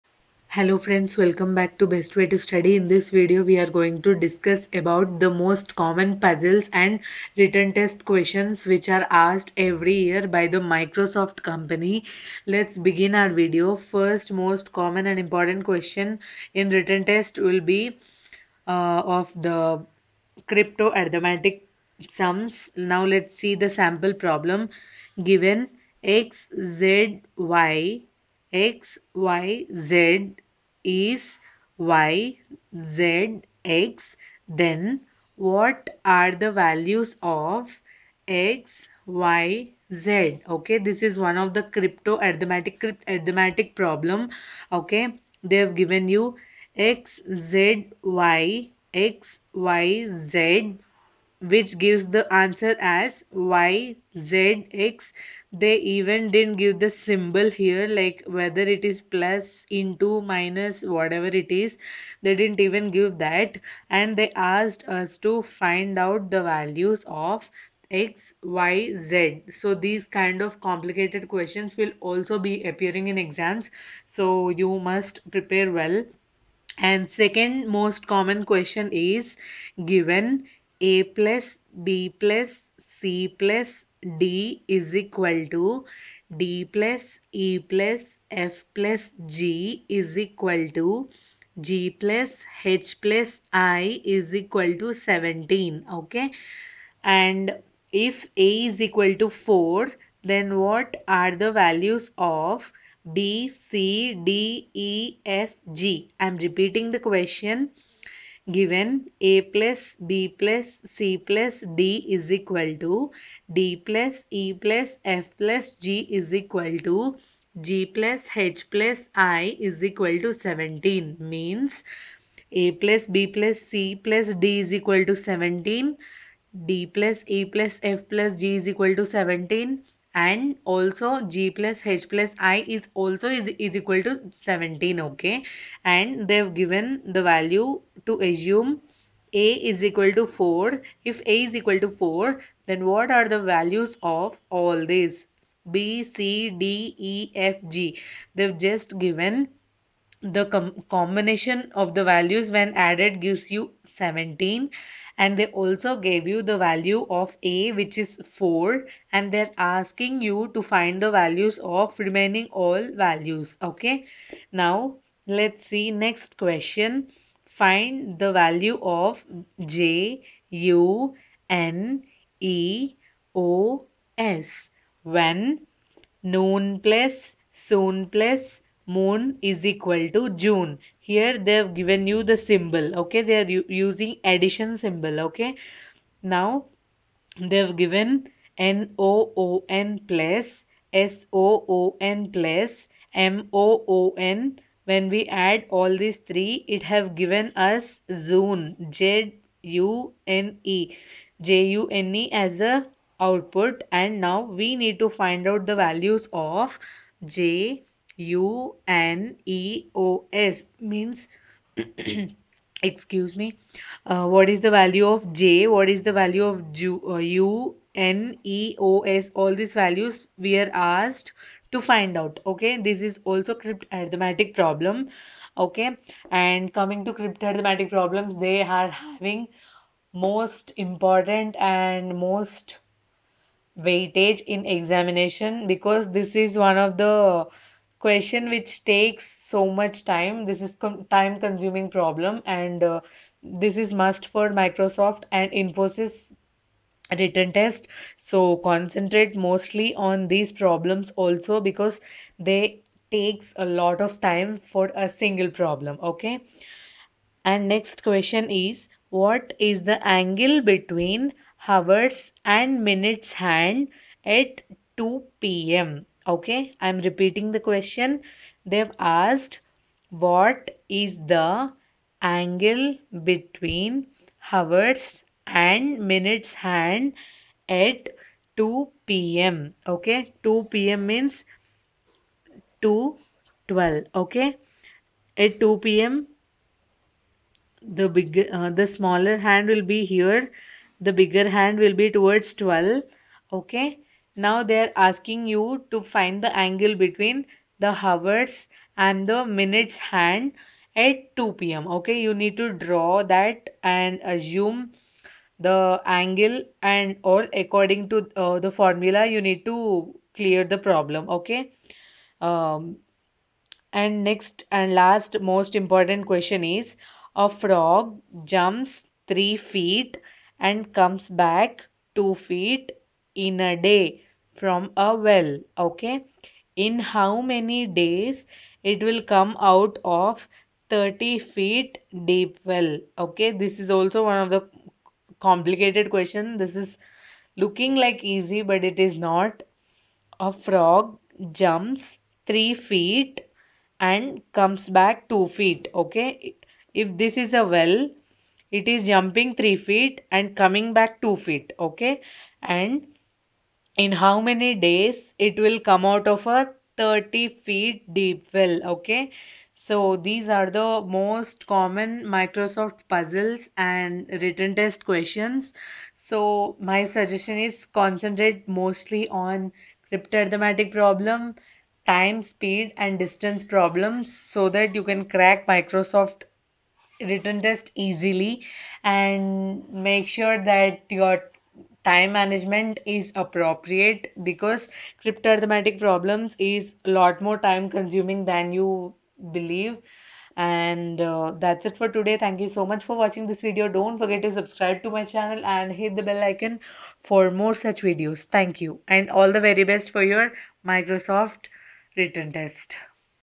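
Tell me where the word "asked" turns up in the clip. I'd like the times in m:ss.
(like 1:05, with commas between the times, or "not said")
0:09, 1:04, 3:40, 4:28.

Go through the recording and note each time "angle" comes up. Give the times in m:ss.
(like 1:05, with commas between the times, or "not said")
4:20, 4:32, 4:56, 5:06.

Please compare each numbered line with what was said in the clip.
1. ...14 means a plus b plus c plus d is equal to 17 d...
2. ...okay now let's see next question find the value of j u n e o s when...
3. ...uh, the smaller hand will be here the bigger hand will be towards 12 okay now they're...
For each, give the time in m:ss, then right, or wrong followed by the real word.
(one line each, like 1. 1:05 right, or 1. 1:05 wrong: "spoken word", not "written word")
1. 2:00 wrong: "17", not "14"
2. 2:43 right
3. 4:48 right.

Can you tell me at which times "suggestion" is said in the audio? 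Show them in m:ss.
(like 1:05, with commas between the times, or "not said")
6:07.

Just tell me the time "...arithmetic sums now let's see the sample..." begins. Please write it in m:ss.
0:21.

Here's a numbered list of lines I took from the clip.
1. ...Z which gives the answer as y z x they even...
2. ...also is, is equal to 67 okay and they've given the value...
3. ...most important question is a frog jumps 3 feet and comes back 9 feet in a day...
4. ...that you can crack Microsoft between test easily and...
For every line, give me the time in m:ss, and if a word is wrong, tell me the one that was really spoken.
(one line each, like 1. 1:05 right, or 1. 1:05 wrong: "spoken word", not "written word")
1. 0:50 right
2. 2:12 wrong: "17", not "67"
3. 5:15 wrong: "2", not "9"
4. 6:14 wrong: "written", not "between".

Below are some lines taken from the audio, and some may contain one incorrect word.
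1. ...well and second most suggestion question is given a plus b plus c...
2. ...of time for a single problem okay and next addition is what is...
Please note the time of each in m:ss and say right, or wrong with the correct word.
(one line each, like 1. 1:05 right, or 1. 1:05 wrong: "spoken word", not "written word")
1. 1:15 wrong: "common", not "suggestion"
2. 4:14 wrong: "question", not "addition".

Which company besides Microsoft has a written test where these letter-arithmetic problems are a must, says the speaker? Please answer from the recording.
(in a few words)
Infosys.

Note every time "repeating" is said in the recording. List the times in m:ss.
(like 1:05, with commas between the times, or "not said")
1:46, 4:26.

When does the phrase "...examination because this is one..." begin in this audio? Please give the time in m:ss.
3:54.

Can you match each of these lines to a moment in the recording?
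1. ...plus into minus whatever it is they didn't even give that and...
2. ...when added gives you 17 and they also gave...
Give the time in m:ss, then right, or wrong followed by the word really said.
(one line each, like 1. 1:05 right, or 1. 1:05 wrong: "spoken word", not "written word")
1. 0:59 right
2. 2:32 right.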